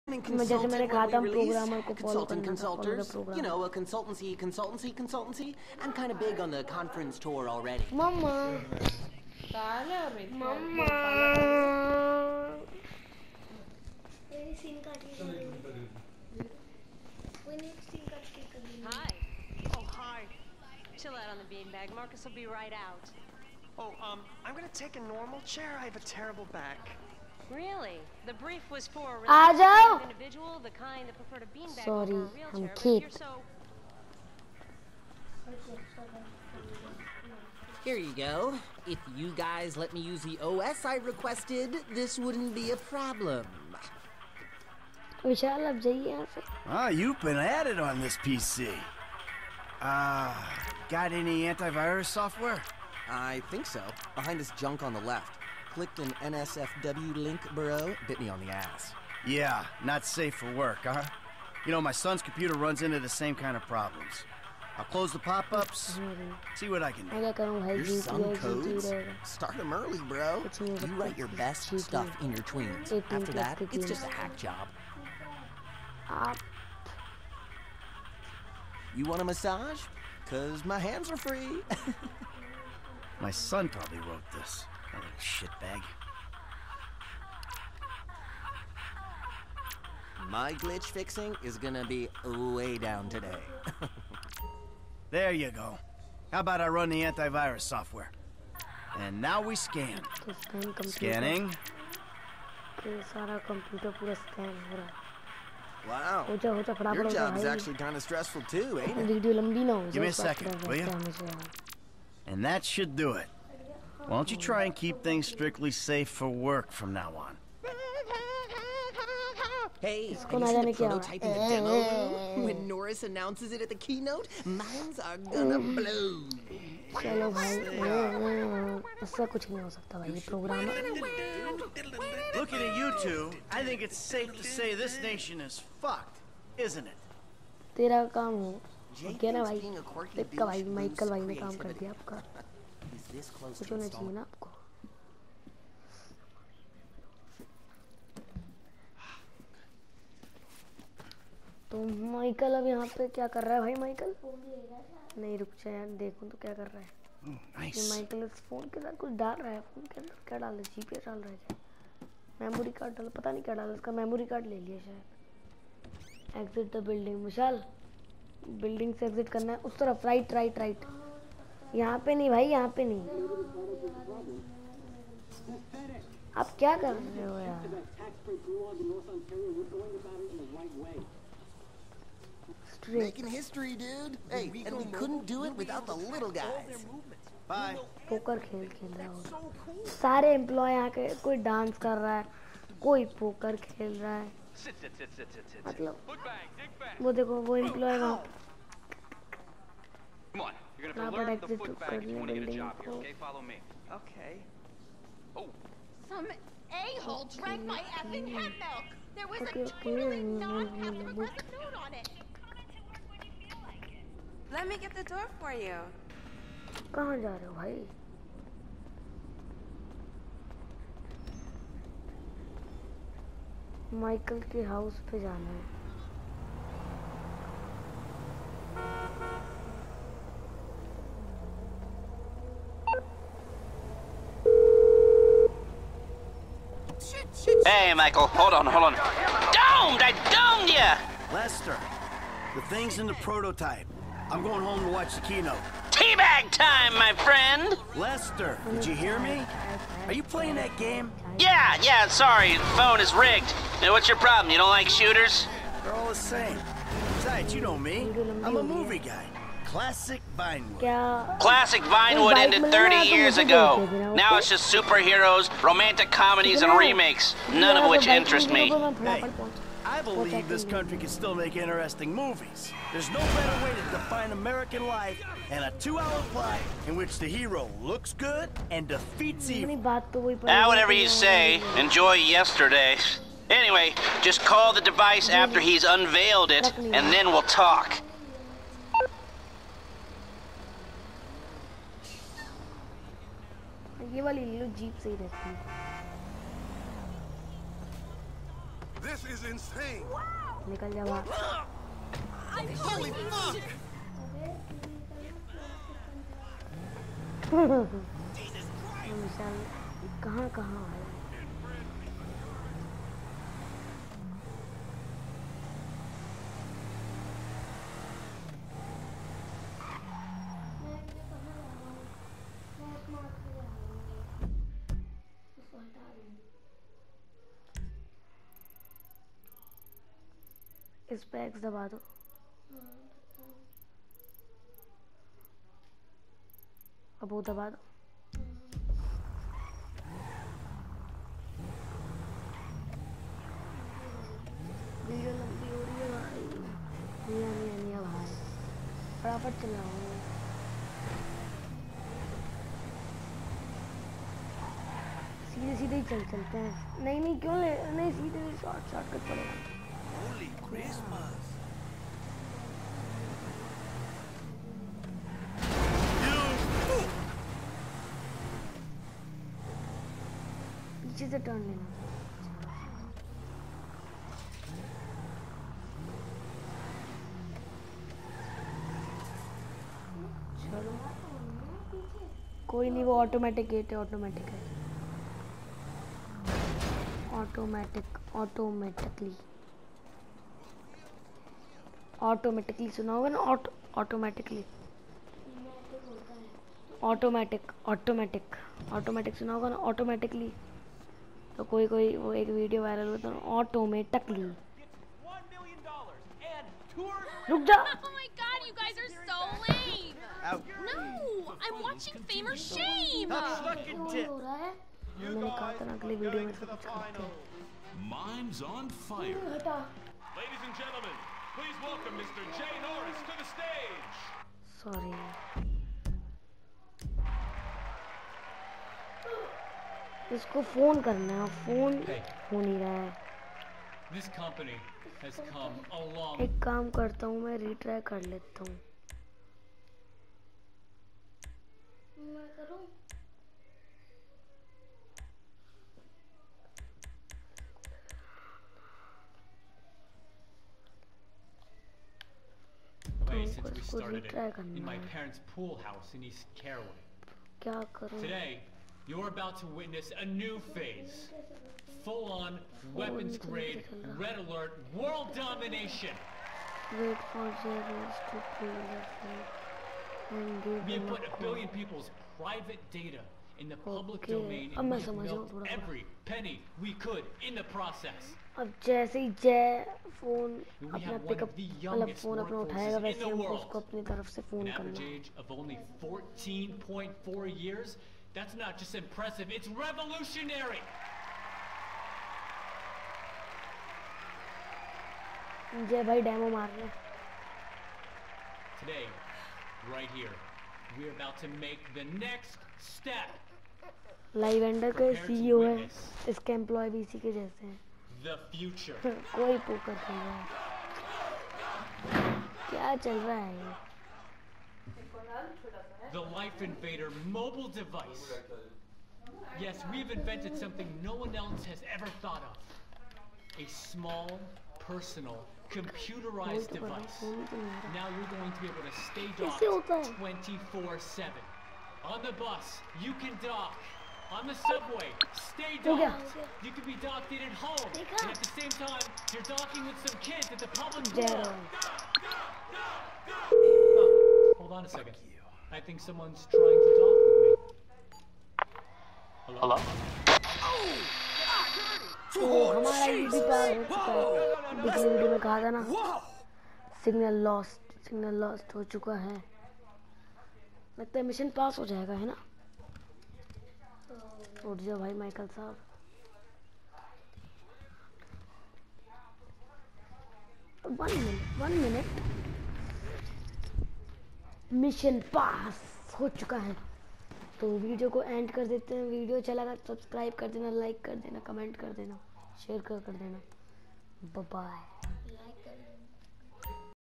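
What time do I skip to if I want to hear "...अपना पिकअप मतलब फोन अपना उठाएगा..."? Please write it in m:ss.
8:00.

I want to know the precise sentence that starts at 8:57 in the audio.
And at the same time, you're docking with some kids at the public school.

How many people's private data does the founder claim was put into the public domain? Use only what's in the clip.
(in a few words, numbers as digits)
a billion.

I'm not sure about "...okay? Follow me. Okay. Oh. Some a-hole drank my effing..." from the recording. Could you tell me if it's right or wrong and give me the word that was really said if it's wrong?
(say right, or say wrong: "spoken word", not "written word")
right.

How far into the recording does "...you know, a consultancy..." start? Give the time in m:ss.
0:03.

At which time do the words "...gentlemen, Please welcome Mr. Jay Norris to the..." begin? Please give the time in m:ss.
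7:00.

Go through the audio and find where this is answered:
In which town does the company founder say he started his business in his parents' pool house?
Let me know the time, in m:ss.
7:36.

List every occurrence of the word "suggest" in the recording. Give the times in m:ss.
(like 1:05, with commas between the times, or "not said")
not said.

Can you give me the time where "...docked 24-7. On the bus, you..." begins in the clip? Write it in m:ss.
8:49.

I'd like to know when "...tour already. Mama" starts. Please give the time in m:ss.
0:07.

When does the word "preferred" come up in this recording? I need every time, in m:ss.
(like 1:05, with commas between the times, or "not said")
0:31.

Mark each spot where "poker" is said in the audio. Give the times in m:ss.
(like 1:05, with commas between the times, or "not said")
3:08, 3:13.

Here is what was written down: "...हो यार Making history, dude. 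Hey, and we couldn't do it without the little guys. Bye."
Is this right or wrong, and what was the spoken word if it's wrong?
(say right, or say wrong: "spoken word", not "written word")
right.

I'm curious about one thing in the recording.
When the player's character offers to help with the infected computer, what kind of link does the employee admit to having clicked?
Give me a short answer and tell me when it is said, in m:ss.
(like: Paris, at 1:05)
NSFW link, at 0:56.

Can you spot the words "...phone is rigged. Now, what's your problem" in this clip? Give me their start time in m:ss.
4:12.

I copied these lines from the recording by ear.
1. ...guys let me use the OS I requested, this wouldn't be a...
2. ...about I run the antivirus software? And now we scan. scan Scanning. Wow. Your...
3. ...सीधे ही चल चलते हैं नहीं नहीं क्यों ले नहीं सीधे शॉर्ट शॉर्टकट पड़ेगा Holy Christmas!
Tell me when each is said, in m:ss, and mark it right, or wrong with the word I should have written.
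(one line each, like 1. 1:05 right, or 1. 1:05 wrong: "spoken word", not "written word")
1. 0:39 right
2. 1:36 right
3. 5:55 right.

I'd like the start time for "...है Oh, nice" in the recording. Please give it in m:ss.
2:36.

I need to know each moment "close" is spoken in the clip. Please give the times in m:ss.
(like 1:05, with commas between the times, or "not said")
1:04, 2:23.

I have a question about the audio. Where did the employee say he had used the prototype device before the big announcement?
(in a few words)
demo room.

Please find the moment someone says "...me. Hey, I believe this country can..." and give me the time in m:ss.
4:28.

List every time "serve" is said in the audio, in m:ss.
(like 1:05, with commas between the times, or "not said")
not said.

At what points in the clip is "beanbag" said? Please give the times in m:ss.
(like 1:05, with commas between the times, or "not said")
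0:21, 0:31.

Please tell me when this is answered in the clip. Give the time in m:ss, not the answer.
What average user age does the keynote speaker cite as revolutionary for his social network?
8:06.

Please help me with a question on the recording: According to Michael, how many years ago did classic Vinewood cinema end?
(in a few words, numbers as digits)
30 years.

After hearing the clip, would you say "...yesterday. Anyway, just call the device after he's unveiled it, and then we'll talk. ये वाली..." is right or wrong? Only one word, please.
right.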